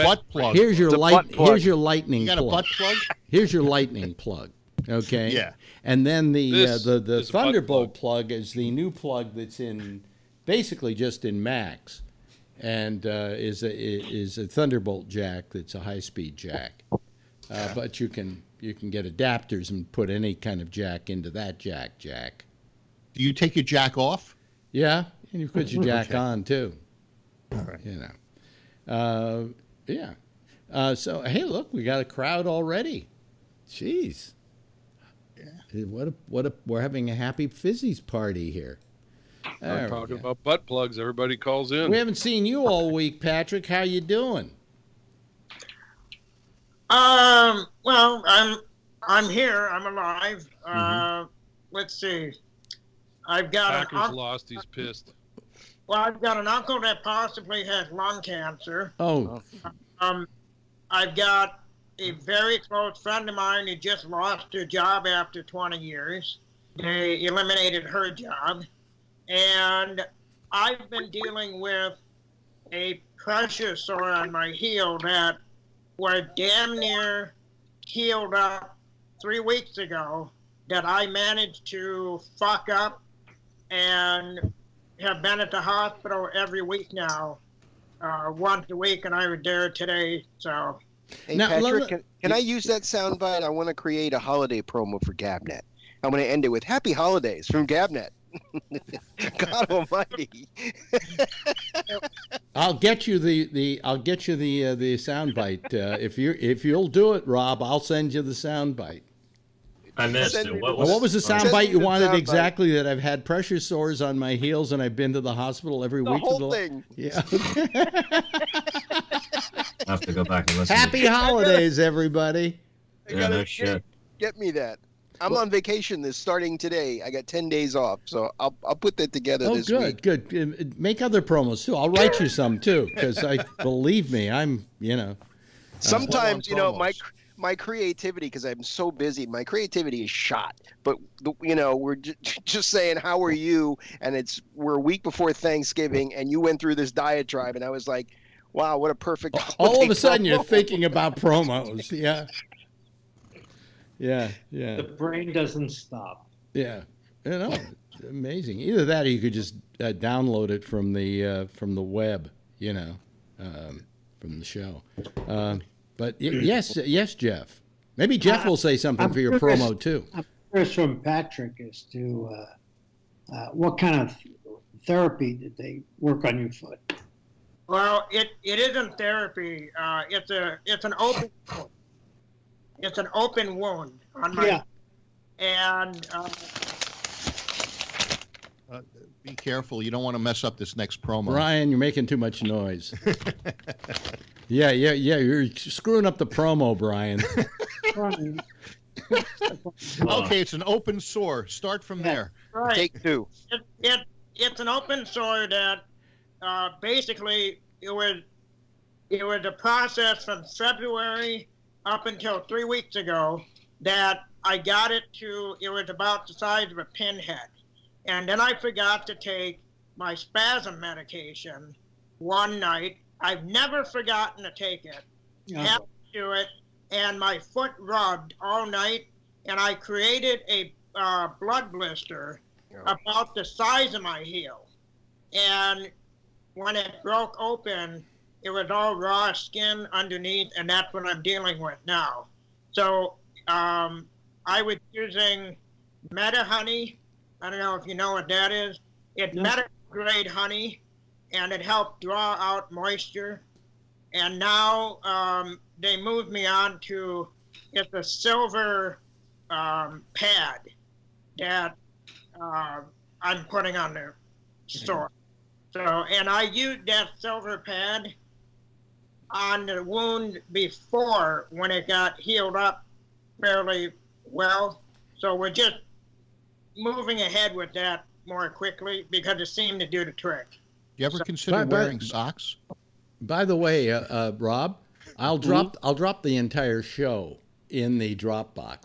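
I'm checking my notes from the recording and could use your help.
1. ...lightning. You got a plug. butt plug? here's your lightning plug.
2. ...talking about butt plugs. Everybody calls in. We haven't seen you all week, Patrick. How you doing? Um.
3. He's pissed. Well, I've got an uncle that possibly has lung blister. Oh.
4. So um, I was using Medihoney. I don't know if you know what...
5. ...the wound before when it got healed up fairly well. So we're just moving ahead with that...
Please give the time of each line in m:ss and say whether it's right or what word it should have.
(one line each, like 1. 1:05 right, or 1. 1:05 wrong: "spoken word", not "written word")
1. 0:01 right
2. 0:39 right
3. 0:54 wrong: "cancer", not "blister"
4. 4:02 right
5. 4:29 right.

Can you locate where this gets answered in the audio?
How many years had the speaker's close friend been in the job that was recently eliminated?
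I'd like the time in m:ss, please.
1:05.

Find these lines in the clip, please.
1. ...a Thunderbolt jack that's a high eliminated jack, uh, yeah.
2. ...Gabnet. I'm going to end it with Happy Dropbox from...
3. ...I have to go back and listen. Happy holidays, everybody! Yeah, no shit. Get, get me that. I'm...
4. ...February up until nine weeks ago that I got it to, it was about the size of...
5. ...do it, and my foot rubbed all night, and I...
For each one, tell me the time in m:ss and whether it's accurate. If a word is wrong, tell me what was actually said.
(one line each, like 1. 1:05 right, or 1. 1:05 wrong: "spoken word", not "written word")
1. 0:14 wrong: "speed", not "eliminated"
2. 1:35 wrong: "Holidays", not "Dropbox"
3. 1:59 right
4. 3:30 wrong: "three", not "nine"
5. 3:46 right.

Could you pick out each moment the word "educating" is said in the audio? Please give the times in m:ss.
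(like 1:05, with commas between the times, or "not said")
not said.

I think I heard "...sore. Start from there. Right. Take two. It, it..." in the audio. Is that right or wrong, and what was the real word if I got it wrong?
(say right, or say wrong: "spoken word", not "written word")
right.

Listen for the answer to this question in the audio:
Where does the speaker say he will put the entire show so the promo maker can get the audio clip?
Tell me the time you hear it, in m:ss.
4:48.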